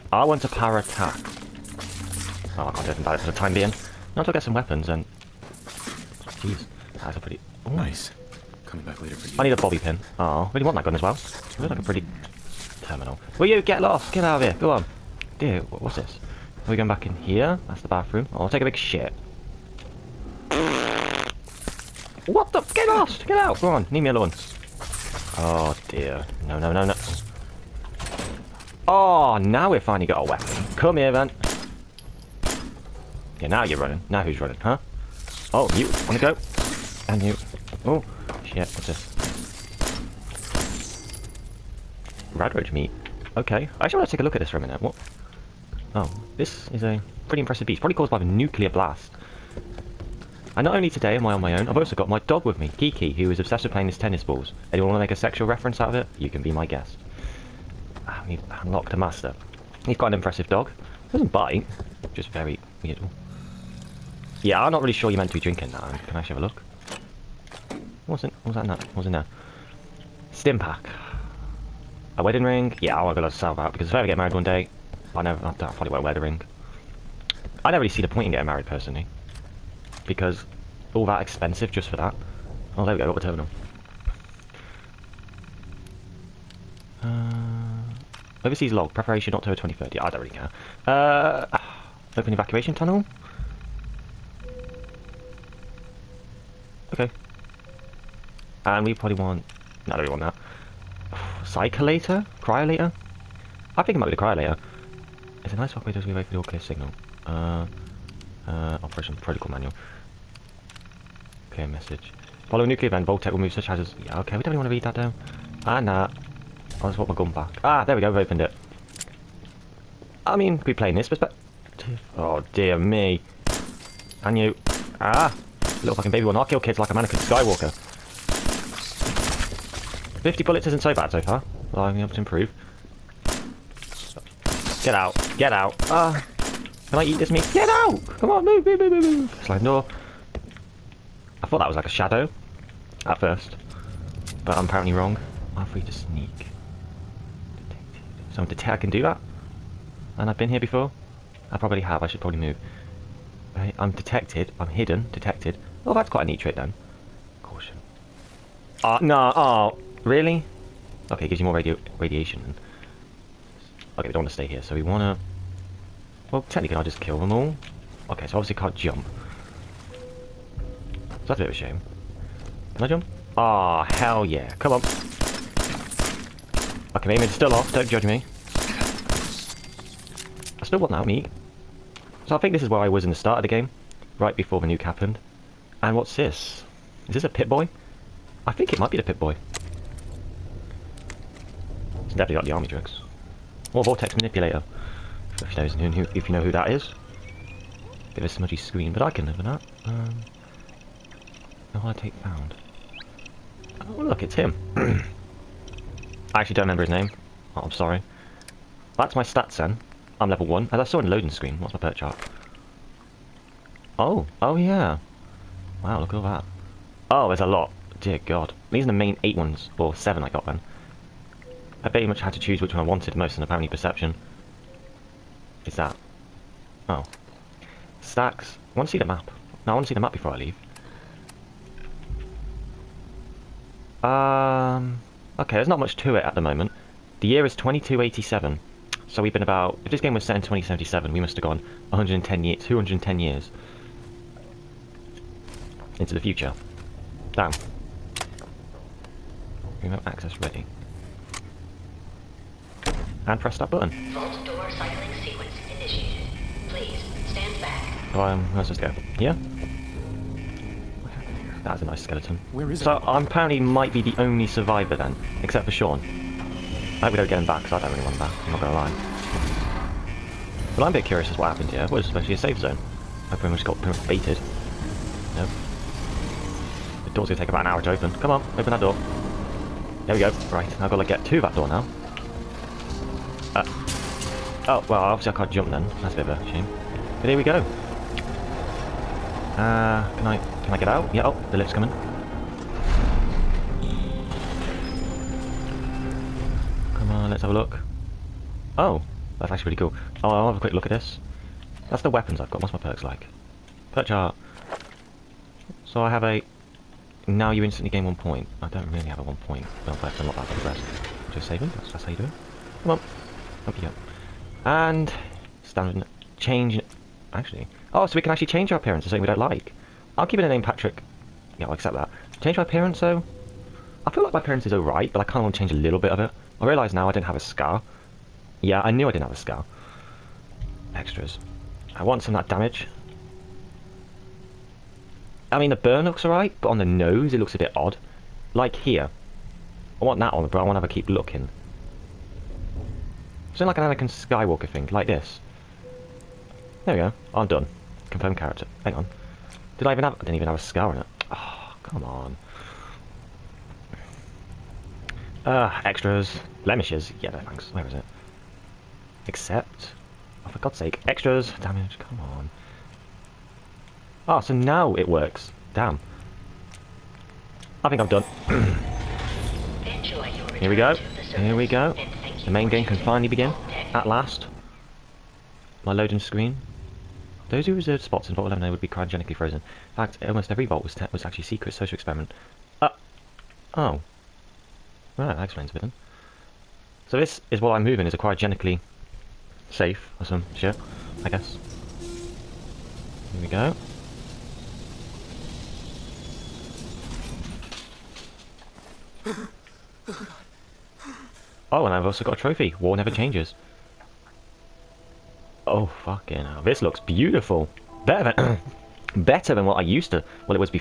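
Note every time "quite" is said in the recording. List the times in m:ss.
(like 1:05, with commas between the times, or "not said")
0:59, 2:36.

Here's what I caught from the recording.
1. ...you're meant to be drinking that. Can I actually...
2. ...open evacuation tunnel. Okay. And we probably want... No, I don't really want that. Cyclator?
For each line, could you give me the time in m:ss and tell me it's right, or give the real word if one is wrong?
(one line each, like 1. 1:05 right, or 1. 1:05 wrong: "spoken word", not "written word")
1. 1:05 right
2. 1:32 right.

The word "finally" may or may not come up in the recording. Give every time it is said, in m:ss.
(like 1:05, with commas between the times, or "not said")
0:29, 6:12.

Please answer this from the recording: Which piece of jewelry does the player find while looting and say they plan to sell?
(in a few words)
A wedding ring.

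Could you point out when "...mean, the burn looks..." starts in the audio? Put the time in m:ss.
5:35.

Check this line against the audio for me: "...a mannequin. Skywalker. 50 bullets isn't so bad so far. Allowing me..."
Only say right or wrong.
right.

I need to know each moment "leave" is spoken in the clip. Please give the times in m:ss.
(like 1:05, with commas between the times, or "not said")
0:23, 3:50.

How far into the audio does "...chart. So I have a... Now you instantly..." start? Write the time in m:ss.
5:04.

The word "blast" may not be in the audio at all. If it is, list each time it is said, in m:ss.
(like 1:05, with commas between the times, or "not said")
0:48.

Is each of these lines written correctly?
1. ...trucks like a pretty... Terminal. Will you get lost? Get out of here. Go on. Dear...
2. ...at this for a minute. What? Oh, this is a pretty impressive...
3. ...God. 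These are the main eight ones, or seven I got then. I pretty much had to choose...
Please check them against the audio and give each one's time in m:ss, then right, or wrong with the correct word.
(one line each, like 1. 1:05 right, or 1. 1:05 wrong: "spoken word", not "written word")
1. 0:11 wrong: "looks", not "trucks"
2. 0:44 right
3. 3:38 right.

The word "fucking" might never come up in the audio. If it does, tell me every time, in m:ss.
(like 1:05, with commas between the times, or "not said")
2:05, 6:46.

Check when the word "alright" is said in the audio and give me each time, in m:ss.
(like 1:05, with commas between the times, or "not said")
5:24, 5:36.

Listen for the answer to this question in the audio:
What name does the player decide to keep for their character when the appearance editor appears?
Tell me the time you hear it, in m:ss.
5:20.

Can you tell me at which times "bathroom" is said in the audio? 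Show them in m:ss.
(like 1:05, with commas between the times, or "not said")
0:17.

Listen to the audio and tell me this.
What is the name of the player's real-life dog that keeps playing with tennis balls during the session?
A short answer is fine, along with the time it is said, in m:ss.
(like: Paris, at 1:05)
Kiki, at 0:52.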